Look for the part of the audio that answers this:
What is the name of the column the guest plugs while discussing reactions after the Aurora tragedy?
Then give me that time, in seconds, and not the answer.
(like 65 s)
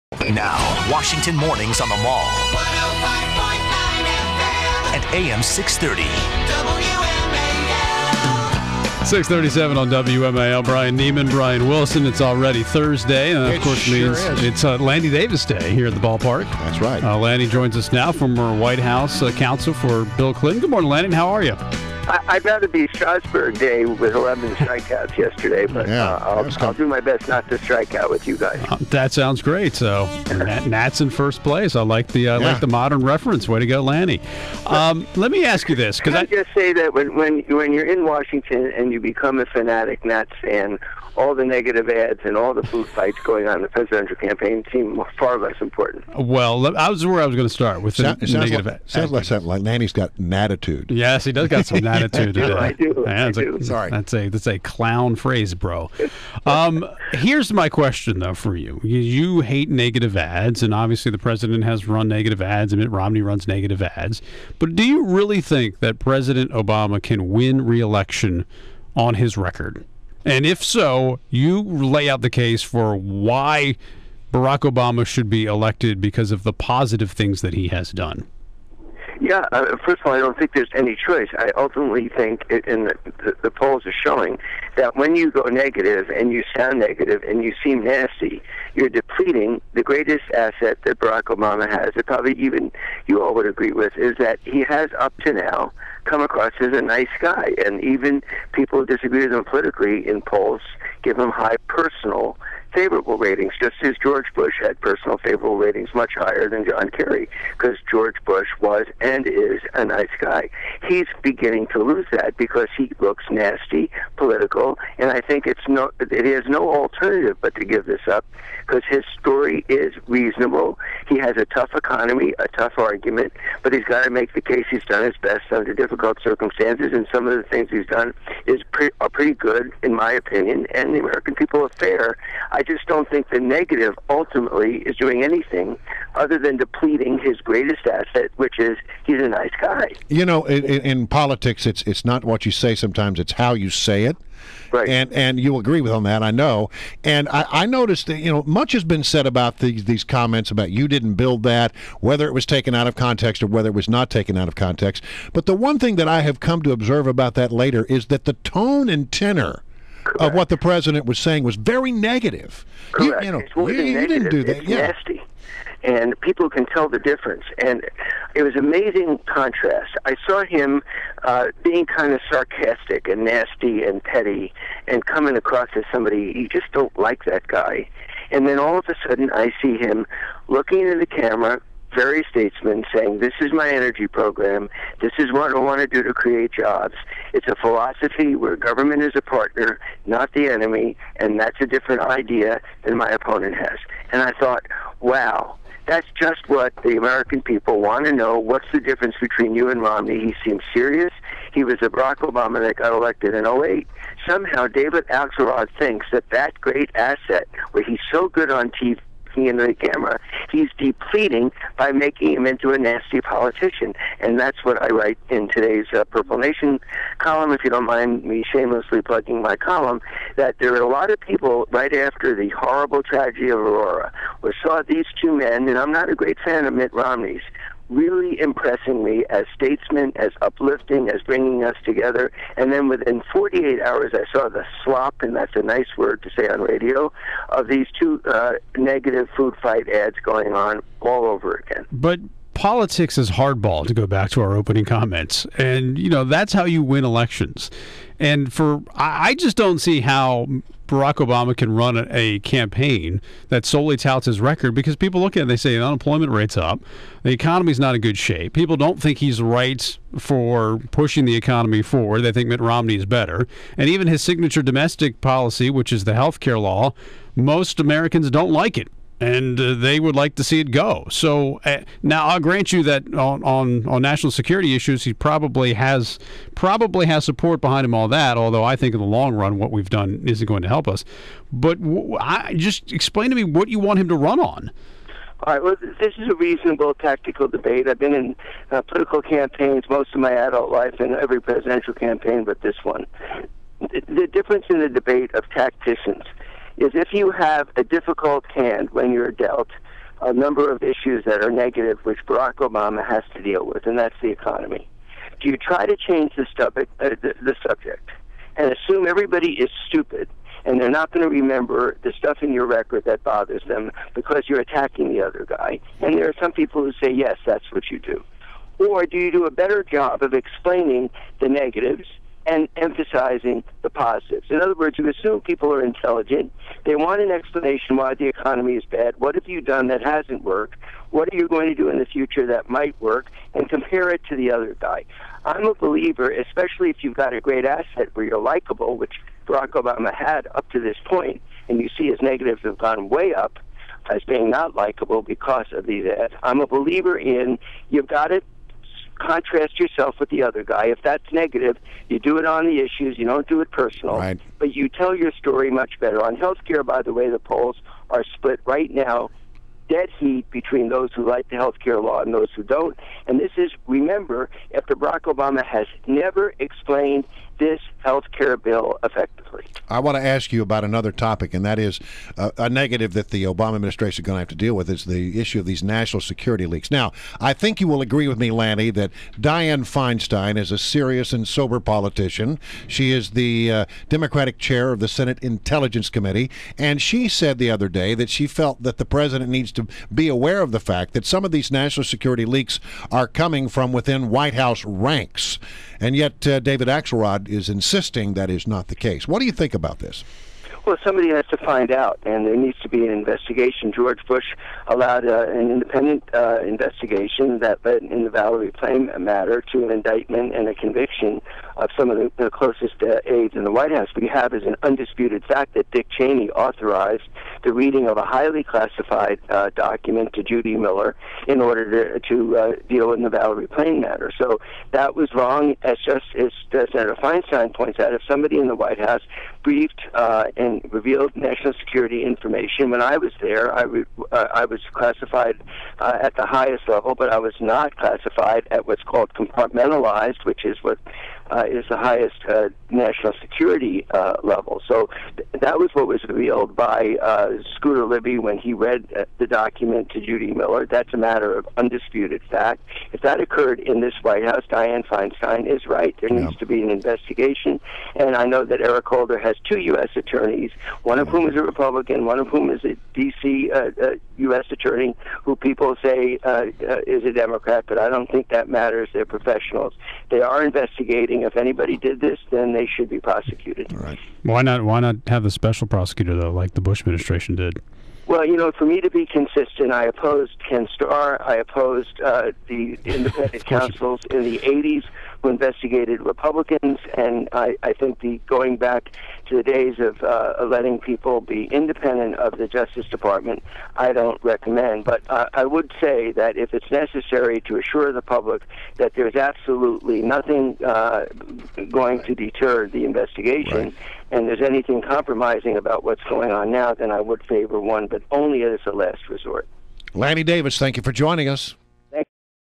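216 s.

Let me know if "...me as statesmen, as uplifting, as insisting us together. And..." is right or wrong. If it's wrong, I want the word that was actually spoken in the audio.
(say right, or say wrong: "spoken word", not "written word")
wrong: "bringing", not "insisting".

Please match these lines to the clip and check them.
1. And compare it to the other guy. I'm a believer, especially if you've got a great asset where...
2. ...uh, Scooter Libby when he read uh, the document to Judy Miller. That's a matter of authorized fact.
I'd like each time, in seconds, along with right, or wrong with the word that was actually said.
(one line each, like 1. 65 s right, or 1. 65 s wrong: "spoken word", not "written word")
1. 333 s right
2. 447 s wrong: "undisputed", not "authorized".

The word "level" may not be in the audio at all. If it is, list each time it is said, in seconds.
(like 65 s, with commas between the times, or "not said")
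436 s, 444 s.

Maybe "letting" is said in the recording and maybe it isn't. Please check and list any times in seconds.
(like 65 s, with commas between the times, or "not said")
490 s.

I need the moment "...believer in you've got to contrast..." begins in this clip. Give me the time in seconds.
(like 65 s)
346 s.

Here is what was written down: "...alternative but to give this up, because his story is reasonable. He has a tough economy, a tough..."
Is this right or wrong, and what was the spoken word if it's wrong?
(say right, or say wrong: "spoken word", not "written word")
right.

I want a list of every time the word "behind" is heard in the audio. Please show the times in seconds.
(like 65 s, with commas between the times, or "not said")
277 s.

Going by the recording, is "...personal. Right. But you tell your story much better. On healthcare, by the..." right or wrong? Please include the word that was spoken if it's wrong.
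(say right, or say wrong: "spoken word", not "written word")
right.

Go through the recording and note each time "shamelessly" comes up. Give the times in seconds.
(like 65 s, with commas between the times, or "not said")
218 s.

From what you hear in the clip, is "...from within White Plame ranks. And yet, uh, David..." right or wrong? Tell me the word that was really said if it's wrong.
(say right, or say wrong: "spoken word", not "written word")
wrong: "House", not "Plame".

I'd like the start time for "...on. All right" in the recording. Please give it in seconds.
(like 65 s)
284 s.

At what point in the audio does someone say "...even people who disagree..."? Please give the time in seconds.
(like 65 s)
97 s.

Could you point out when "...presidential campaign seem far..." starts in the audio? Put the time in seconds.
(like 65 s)
43 s.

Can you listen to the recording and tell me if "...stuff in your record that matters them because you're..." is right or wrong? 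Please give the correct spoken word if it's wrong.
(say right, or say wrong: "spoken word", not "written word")
wrong: "bothers", not "matters".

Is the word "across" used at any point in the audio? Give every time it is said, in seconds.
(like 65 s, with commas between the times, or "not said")
96 s, 175 s.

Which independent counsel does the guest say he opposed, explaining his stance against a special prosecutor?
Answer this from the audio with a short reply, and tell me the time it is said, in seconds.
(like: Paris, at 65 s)
Ken Starr, at 480 s.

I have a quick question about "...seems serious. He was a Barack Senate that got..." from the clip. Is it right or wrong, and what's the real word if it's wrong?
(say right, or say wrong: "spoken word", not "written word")
wrong: "Obama", not "Senate".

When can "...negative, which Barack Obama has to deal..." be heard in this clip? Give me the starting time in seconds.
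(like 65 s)
301 s.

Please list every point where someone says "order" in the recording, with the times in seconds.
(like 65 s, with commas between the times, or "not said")
421 s.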